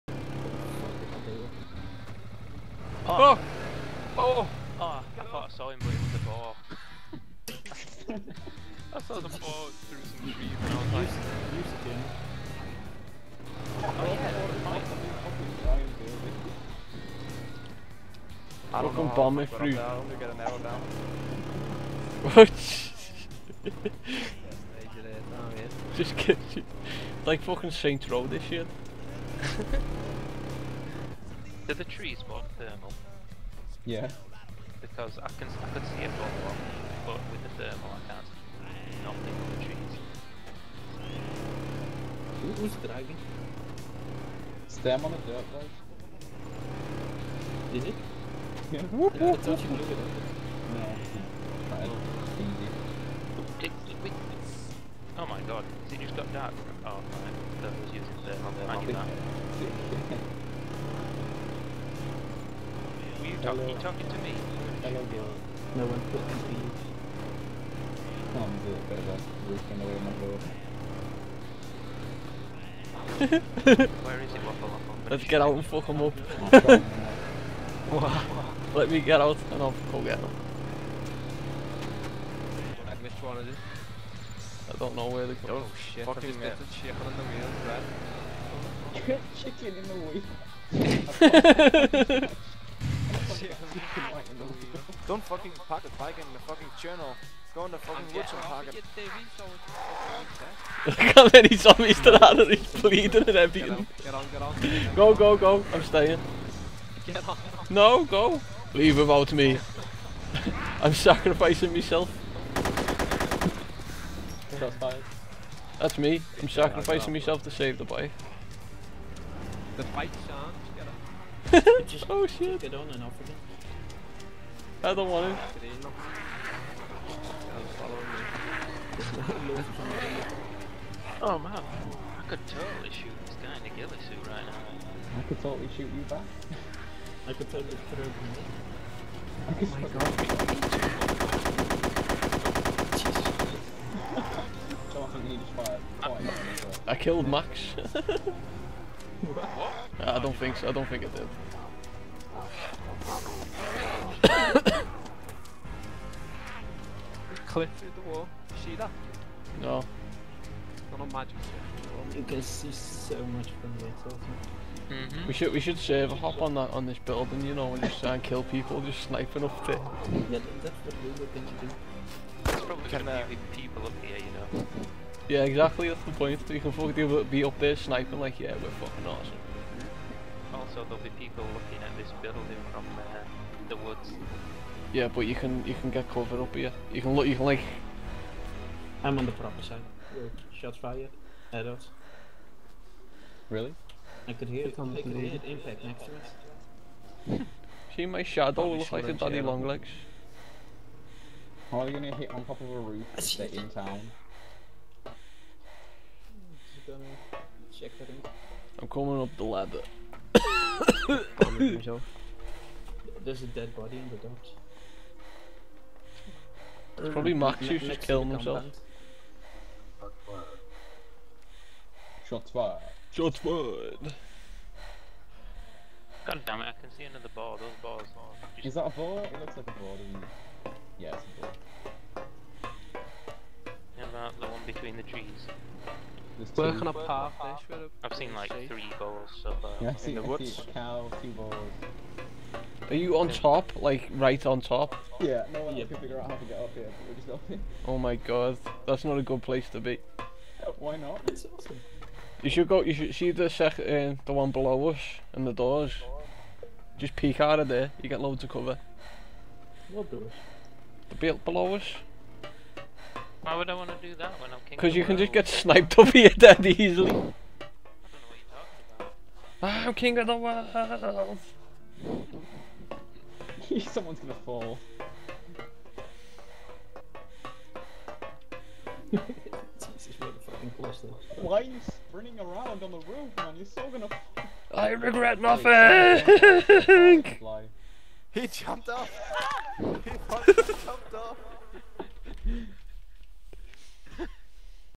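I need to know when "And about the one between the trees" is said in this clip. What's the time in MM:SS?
03:53.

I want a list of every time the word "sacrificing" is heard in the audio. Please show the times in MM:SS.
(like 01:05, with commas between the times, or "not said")
01:50, 01:56.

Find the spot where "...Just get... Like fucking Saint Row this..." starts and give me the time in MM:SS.
00:25.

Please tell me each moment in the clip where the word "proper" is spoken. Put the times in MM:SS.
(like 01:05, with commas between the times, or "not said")
03:09.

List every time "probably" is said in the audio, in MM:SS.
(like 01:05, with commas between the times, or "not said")
02:52, 03:37.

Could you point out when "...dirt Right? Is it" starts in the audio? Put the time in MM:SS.
00:45.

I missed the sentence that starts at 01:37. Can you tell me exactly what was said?
Go in the fucking woods and park it.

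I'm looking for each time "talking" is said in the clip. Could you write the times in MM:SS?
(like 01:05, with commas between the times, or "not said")
01:03, 04:28.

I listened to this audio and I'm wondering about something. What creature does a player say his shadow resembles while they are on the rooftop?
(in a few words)
daddy long legs.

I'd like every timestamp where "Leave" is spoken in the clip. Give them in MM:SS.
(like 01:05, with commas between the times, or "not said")
01:48.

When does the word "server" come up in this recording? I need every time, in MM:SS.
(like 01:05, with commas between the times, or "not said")
02:45.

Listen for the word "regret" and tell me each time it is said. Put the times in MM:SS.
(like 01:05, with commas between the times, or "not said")
04:44.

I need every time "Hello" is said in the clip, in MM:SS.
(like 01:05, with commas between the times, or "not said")
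01:04.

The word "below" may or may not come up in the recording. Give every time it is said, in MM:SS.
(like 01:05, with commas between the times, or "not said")
04:14, 04:21.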